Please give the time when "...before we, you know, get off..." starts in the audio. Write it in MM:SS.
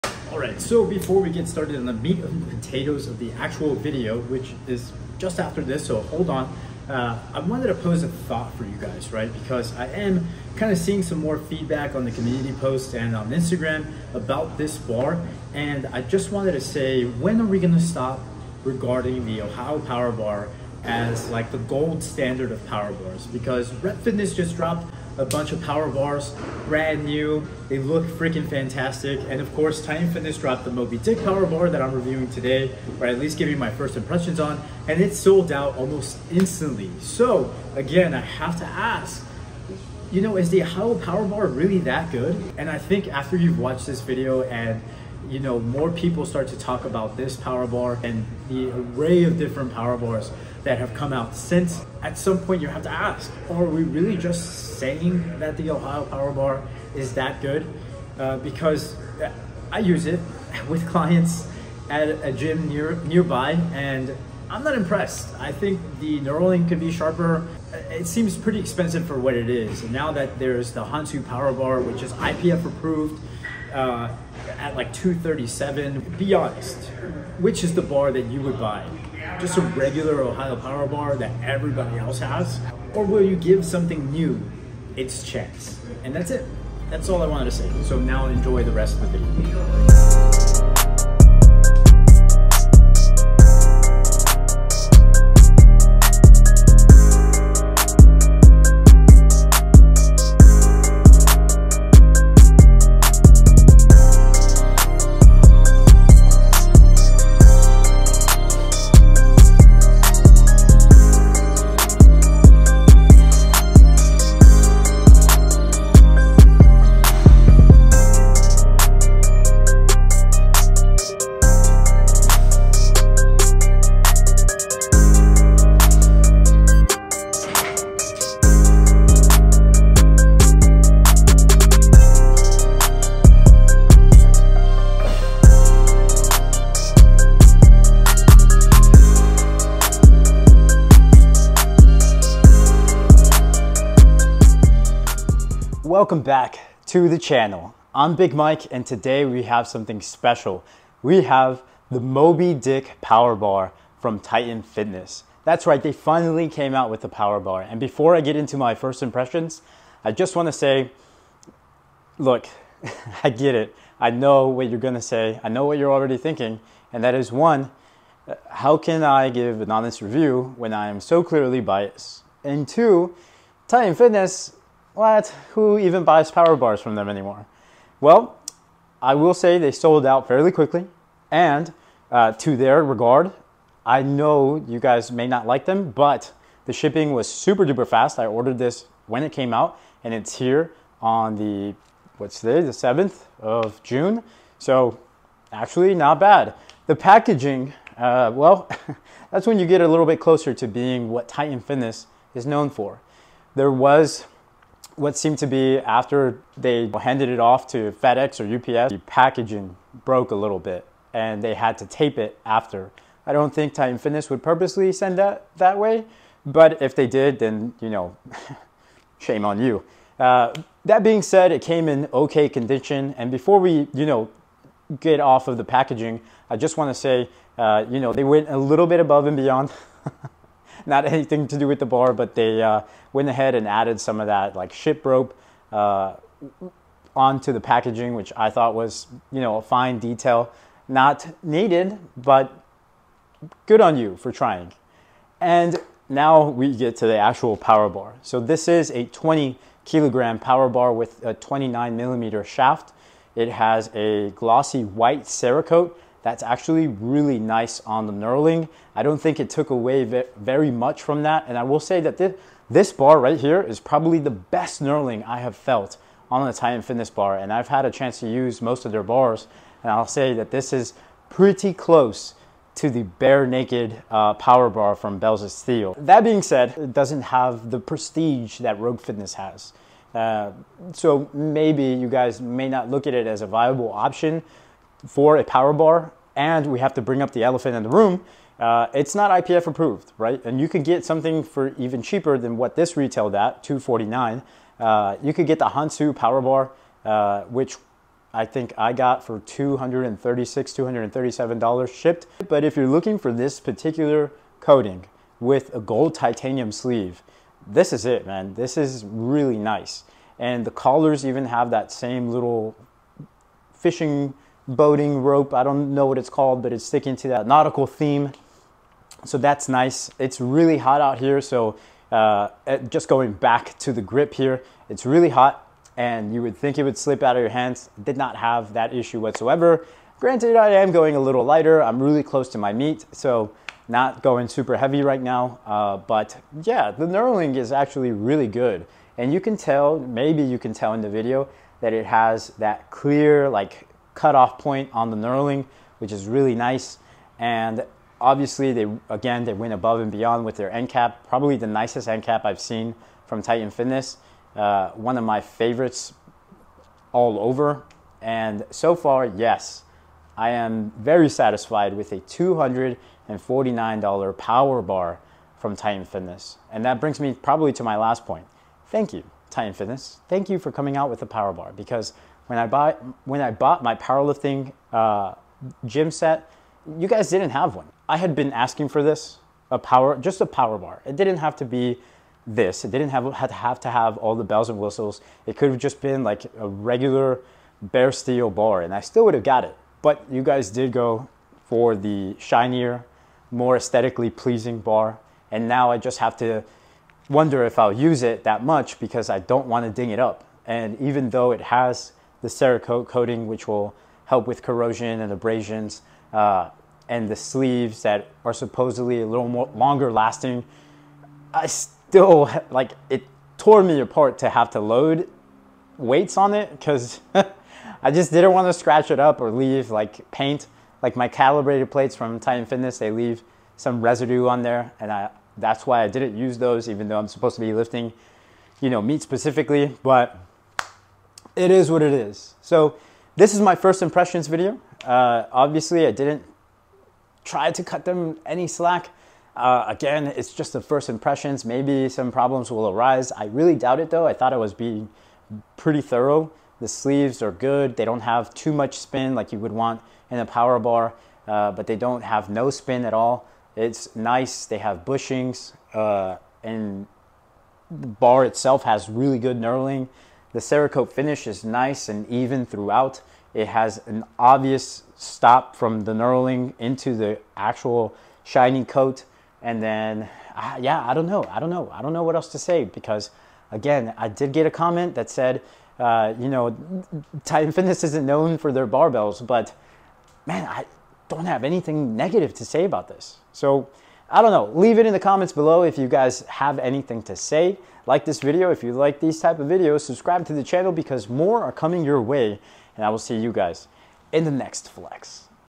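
03:43.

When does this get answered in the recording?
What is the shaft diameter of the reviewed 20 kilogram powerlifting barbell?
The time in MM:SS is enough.
04:11.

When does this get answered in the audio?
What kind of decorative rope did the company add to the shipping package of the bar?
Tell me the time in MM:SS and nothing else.
03:54.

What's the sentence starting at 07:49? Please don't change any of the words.
And then, uh, yeah, I don't know.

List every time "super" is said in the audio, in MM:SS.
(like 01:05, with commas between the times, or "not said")
03:07, 05:34.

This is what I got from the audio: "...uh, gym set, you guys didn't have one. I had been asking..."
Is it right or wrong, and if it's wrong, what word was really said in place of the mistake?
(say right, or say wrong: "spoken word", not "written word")
right.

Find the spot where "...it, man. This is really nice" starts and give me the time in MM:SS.
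05:08.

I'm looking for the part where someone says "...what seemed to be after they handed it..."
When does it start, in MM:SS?
03:25.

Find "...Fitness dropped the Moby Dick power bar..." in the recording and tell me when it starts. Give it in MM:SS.
00:30.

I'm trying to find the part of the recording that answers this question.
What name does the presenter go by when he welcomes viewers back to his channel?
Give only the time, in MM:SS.
02:28.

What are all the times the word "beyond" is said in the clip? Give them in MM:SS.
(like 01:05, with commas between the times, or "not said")
03:49, 05:50.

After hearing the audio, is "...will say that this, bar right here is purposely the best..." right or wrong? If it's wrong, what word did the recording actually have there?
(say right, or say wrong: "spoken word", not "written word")
wrong: "probably", not "purposely".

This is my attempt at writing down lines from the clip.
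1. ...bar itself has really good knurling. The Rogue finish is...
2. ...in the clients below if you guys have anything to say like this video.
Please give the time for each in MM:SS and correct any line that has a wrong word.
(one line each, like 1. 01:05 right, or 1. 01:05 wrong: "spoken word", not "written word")
1. 07:38 wrong: "Cerakote", not "Rogue"
2. 08:05 wrong: "comments", not "clients".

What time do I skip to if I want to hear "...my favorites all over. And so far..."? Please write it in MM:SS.
05:55.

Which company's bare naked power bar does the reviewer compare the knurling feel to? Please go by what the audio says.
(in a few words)
Bells of Steel.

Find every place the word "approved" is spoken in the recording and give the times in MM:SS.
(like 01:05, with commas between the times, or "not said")
01:12, 04:49.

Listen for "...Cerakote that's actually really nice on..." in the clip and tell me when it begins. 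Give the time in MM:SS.
04:15.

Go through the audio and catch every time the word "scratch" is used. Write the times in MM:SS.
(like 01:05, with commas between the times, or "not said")
06:58.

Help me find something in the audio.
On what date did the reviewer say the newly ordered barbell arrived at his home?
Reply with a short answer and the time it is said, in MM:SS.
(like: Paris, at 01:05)
7th of June, at 03:12.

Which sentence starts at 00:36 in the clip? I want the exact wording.
So again, I have to ask, you know, is the Apollo power bar really that good?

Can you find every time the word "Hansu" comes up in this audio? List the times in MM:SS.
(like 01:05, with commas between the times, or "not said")
01:10, 04:55.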